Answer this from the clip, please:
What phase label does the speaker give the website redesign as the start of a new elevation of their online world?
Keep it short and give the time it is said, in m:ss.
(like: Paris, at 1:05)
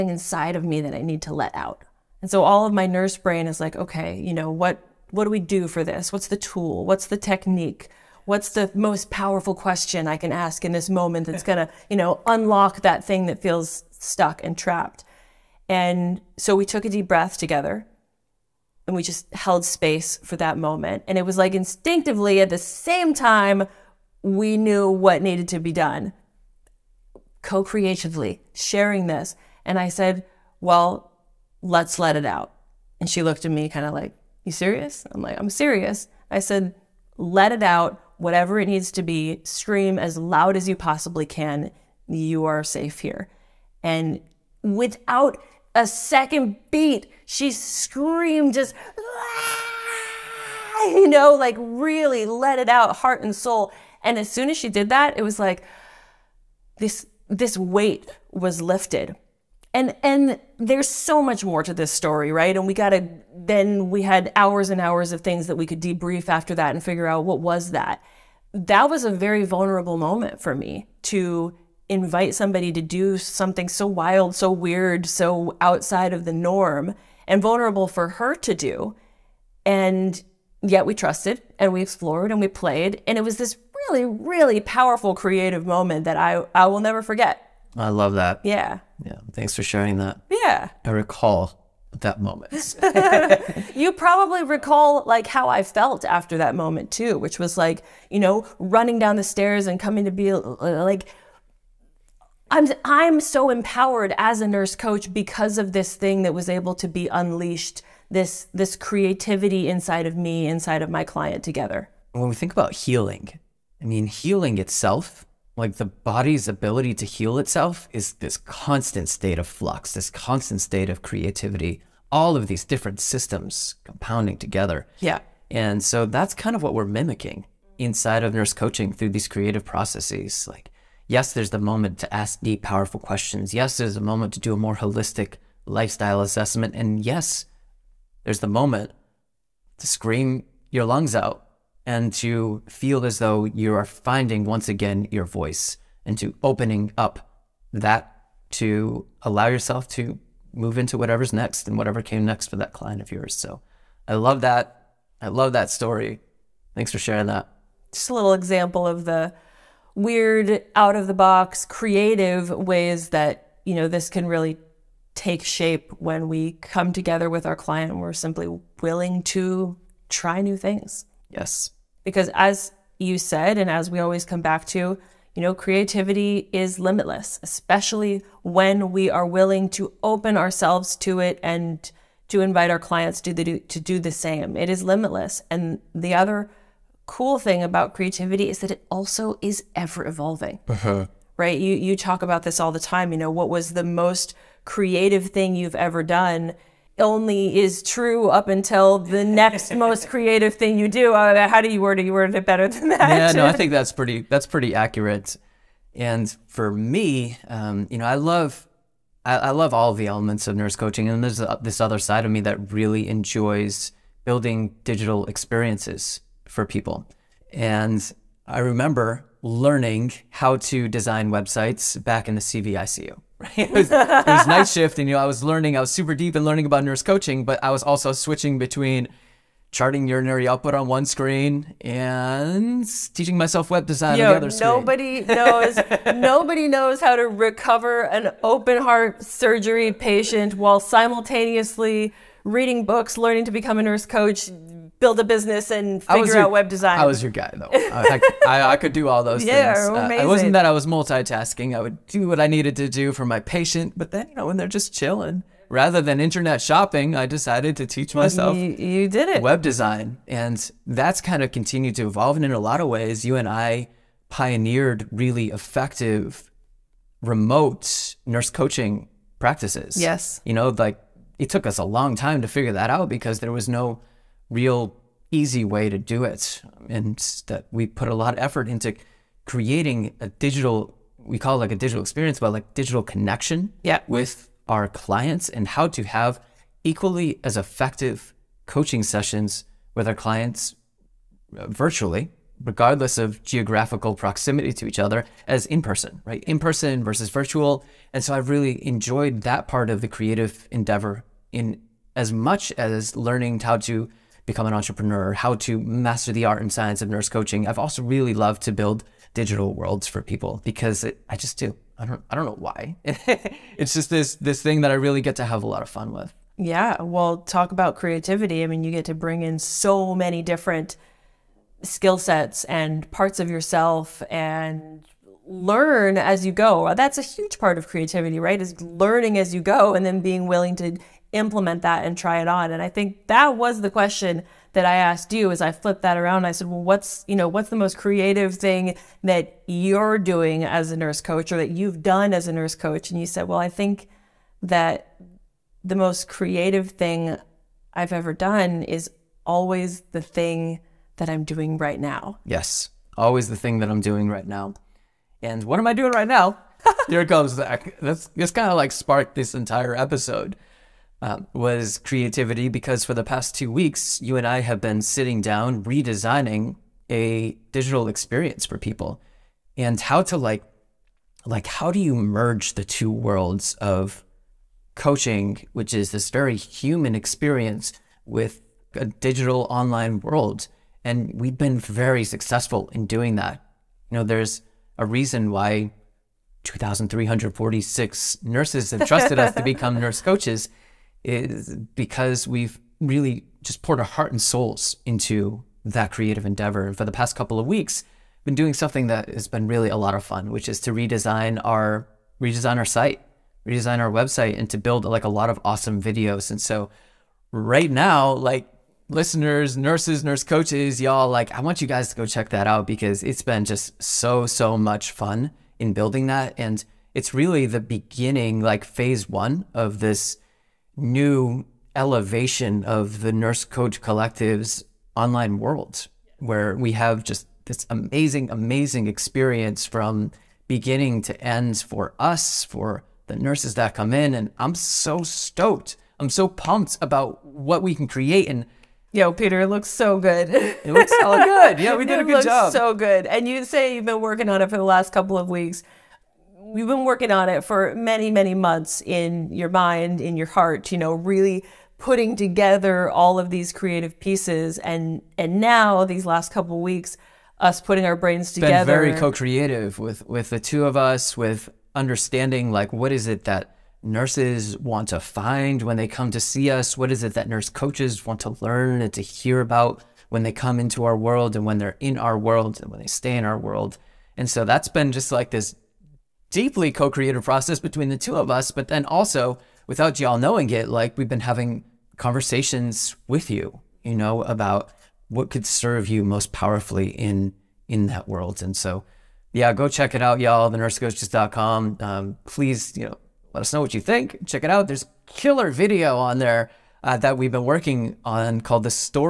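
Phase one, at 6:58.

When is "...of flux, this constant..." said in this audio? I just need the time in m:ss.
1:59.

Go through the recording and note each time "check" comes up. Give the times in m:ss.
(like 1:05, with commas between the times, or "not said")
6:52, 8:09, 8:14.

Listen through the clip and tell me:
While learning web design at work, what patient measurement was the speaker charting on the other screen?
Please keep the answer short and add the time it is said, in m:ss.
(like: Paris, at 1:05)
Urinary output, at 3:50.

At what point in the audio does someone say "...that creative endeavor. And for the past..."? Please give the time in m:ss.
6:35.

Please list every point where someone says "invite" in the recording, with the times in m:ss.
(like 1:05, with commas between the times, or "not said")
1:11, 3:02.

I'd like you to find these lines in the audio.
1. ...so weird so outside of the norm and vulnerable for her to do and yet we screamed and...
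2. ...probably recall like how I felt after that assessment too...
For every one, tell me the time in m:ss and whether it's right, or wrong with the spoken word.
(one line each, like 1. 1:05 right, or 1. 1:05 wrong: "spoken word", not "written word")
1. 1:14 wrong: "trusted", not "screamed"
2. 1:33 wrong: "moment", not "assessment".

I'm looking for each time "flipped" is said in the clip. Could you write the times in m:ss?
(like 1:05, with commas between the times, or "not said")
5:35.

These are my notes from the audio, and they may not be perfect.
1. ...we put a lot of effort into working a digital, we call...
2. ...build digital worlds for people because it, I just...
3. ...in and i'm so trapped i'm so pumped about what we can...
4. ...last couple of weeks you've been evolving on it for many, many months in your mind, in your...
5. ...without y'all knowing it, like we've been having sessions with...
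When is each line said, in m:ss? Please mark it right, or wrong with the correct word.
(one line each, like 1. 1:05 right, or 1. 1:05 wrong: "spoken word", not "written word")
1. 4:37 wrong: "creating", not "working"
2. 5:08 right
3. 7:14 wrong: "stoked", not "trapped"
4. 7:24 wrong: "working", not "evolving"
5. 7:59 wrong: "conversations", not "sessions".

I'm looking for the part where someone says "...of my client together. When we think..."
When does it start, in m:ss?
1:50.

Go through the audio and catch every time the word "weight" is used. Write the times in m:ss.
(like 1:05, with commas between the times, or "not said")
0:57.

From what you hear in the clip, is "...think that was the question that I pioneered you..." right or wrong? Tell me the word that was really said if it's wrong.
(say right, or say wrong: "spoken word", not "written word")
wrong: "asked", not "pioneered".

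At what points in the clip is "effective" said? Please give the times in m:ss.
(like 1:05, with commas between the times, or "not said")
4:25, 4:47.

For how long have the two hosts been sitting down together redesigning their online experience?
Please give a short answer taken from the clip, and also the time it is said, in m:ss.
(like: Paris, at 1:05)
Two weeks, at 6:03.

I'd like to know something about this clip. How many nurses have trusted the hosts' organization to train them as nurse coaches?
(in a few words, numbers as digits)
2346.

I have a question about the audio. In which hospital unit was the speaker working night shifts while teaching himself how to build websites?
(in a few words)
CVICU.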